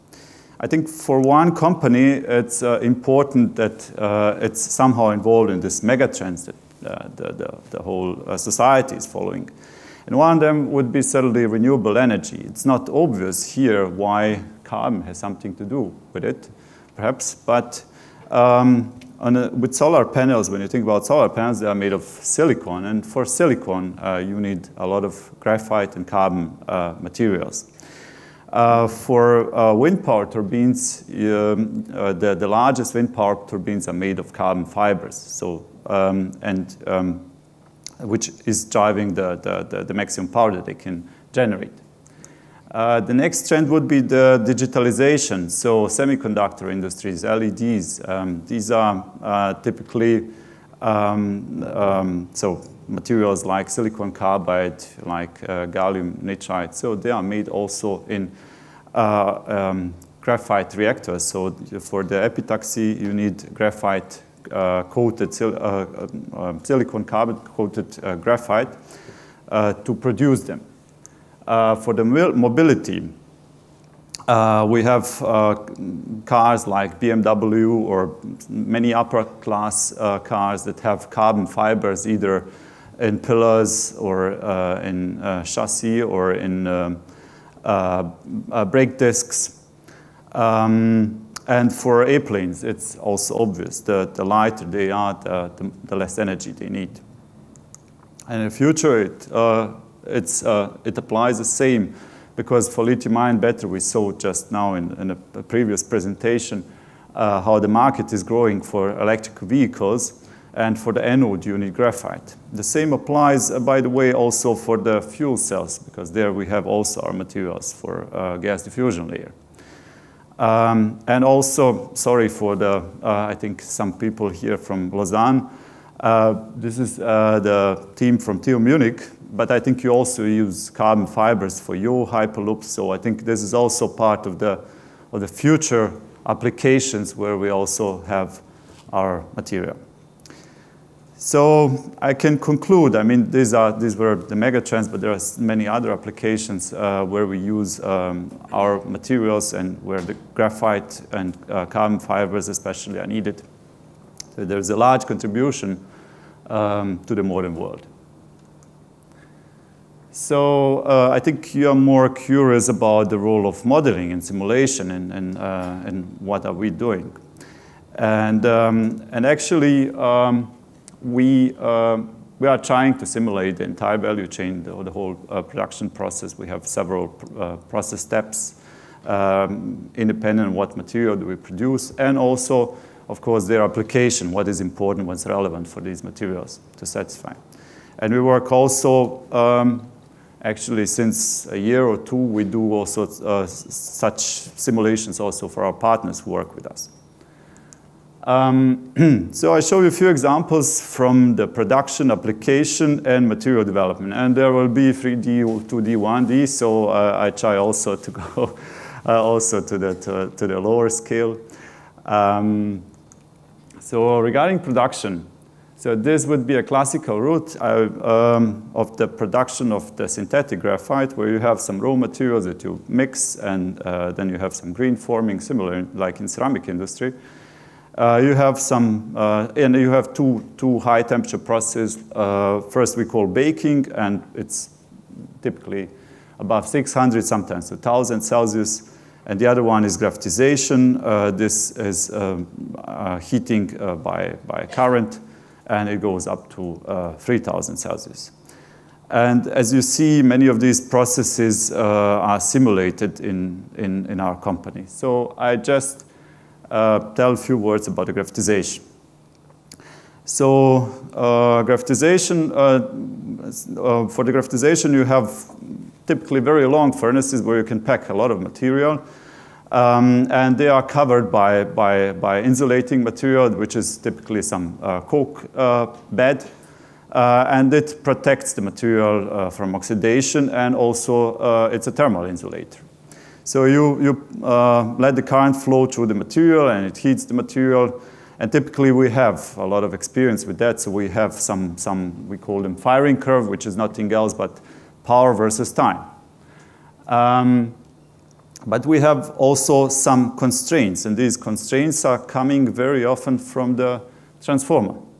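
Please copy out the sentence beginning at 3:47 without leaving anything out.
Uh, you have some, uh, and you have two, two high temperature processes.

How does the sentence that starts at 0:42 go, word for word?
Uh, the next trend would be the digitalization.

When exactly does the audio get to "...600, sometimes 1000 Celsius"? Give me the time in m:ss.
3:56.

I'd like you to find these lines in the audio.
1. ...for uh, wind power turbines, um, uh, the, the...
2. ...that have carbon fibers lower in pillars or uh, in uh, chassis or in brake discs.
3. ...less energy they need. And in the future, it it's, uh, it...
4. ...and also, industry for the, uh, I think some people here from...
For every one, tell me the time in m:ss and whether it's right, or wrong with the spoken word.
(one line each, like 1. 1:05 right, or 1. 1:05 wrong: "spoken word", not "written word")
1. 0:28 right
2. 1:20 wrong: "either", not "lower"
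3. 1:35 right
4. 2:01 wrong: "sorry", not "industry".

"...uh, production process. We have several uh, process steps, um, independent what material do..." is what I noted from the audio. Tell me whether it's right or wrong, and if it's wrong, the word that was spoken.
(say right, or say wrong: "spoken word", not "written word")
right.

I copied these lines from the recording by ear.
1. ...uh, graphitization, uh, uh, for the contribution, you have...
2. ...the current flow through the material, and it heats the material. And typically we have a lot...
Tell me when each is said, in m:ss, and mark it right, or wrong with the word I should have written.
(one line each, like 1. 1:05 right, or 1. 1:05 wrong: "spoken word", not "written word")
1. 4:21 wrong: "graphitization", not "contribution"
2. 4:45 right.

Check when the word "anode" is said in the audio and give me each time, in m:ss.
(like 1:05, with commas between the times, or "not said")
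1:51.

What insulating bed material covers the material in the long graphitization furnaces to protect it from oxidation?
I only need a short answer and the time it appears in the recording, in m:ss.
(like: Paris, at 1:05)
cork, at 4:35.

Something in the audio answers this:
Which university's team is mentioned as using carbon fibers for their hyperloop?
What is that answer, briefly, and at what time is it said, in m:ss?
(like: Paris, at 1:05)
TU Munich, at 2:08.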